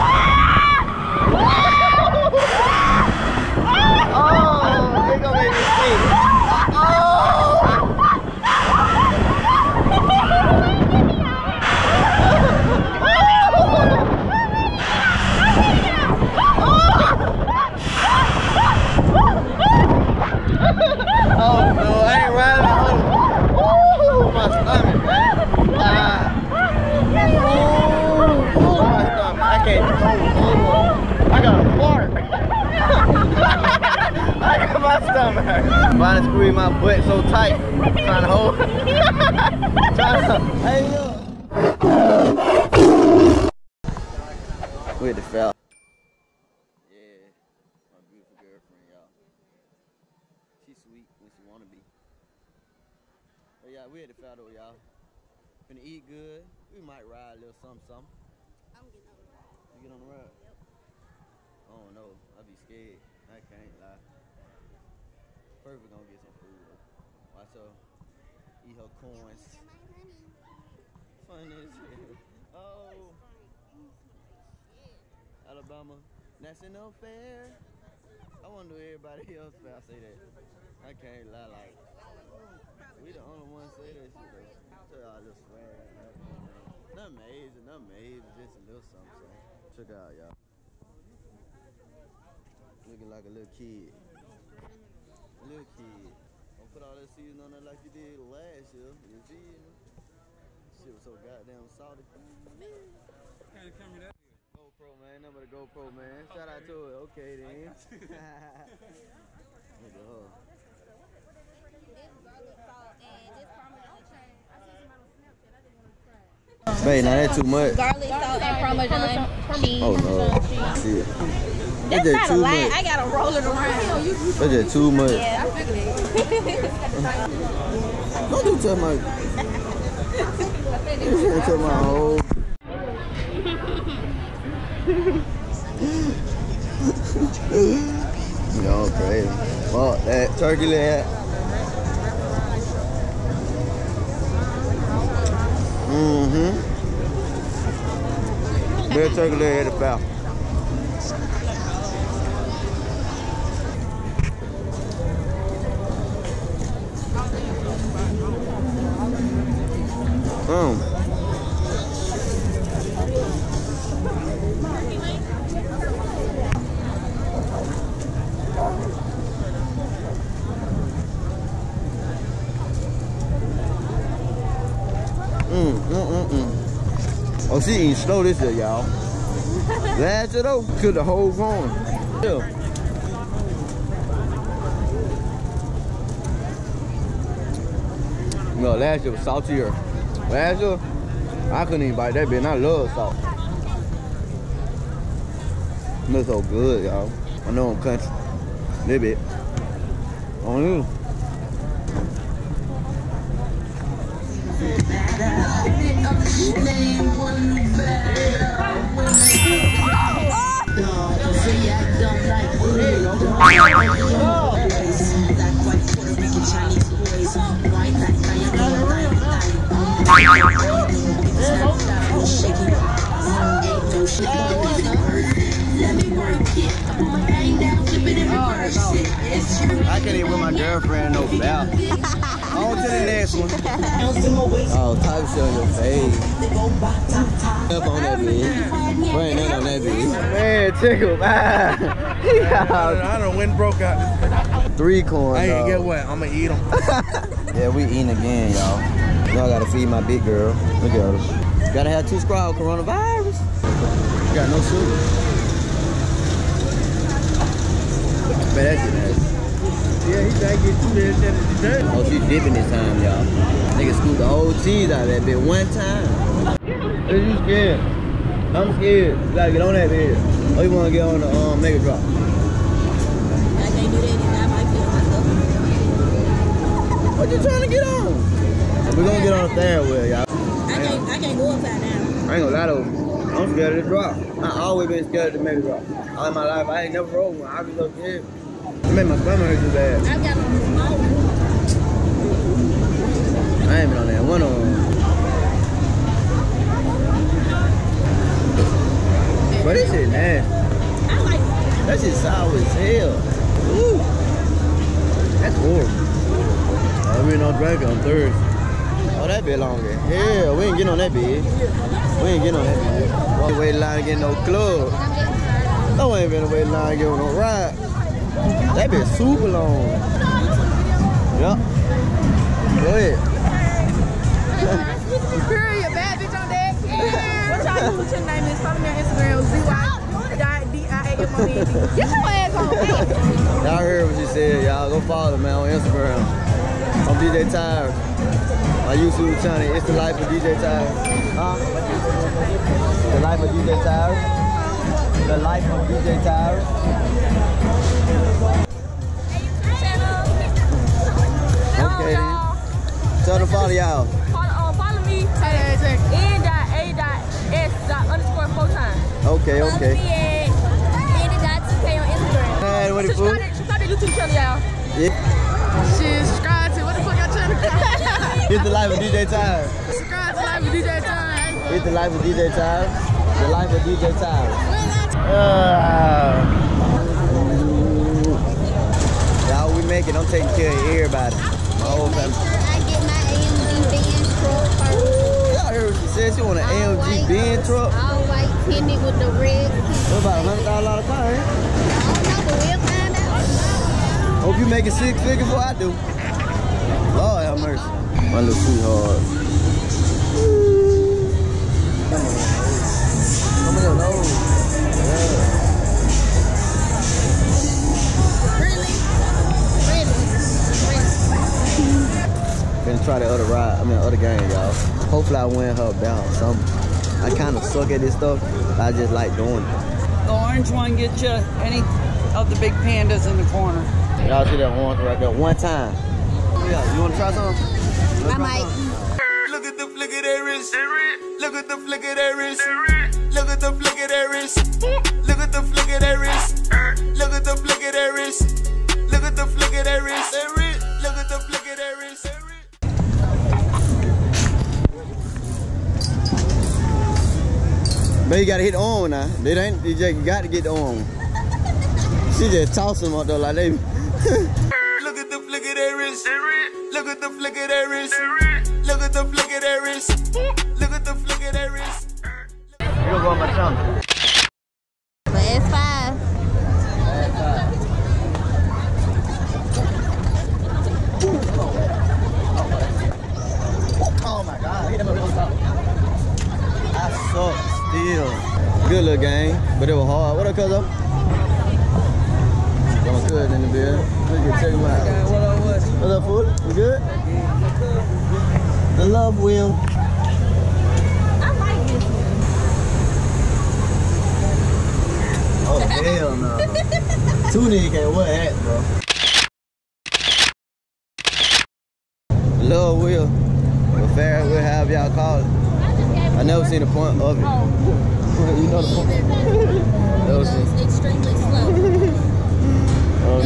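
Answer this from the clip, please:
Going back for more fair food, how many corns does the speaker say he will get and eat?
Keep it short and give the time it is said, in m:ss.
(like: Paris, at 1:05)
3, at 4:04.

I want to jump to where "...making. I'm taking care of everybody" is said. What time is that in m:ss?
6:19.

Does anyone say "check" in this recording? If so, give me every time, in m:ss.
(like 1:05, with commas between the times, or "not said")
1:29, 8:04.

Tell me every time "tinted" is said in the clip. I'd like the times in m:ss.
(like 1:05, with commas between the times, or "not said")
6:28.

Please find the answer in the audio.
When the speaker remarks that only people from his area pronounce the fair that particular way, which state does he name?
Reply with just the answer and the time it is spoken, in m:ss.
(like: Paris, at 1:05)
Alabama, at 1:15.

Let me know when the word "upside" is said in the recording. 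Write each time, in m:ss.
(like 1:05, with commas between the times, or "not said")
4:41.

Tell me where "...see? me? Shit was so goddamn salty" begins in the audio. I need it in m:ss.
1:39.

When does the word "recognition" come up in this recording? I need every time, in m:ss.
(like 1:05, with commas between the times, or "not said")
not said.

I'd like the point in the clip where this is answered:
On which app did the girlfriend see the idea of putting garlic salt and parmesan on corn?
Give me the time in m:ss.
1:55.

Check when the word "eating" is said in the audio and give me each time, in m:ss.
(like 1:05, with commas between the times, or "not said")
2:57, 4:07.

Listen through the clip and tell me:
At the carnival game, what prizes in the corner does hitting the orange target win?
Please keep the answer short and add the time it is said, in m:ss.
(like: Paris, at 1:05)
big pandas, at 7:02.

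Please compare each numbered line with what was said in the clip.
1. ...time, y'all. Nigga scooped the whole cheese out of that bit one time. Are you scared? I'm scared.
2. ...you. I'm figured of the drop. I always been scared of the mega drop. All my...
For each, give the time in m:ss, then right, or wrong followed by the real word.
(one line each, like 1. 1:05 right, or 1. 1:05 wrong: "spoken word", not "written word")
1. 4:22 right
2. 4:42 wrong: "scared", not "figured".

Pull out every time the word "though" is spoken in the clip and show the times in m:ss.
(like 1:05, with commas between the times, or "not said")
0:54, 1:24, 3:00.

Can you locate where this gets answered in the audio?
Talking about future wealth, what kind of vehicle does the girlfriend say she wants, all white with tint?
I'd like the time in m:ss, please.
6:27.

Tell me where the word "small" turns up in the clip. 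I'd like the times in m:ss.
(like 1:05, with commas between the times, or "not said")
4:50.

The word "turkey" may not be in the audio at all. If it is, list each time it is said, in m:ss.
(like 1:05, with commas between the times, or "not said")
2:20, 2:29.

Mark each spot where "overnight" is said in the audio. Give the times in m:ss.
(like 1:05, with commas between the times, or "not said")
not said.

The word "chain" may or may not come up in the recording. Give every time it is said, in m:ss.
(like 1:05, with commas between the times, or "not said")
not said.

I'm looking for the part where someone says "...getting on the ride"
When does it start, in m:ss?
0:58.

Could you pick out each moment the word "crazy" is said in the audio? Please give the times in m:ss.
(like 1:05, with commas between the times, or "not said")
2:18.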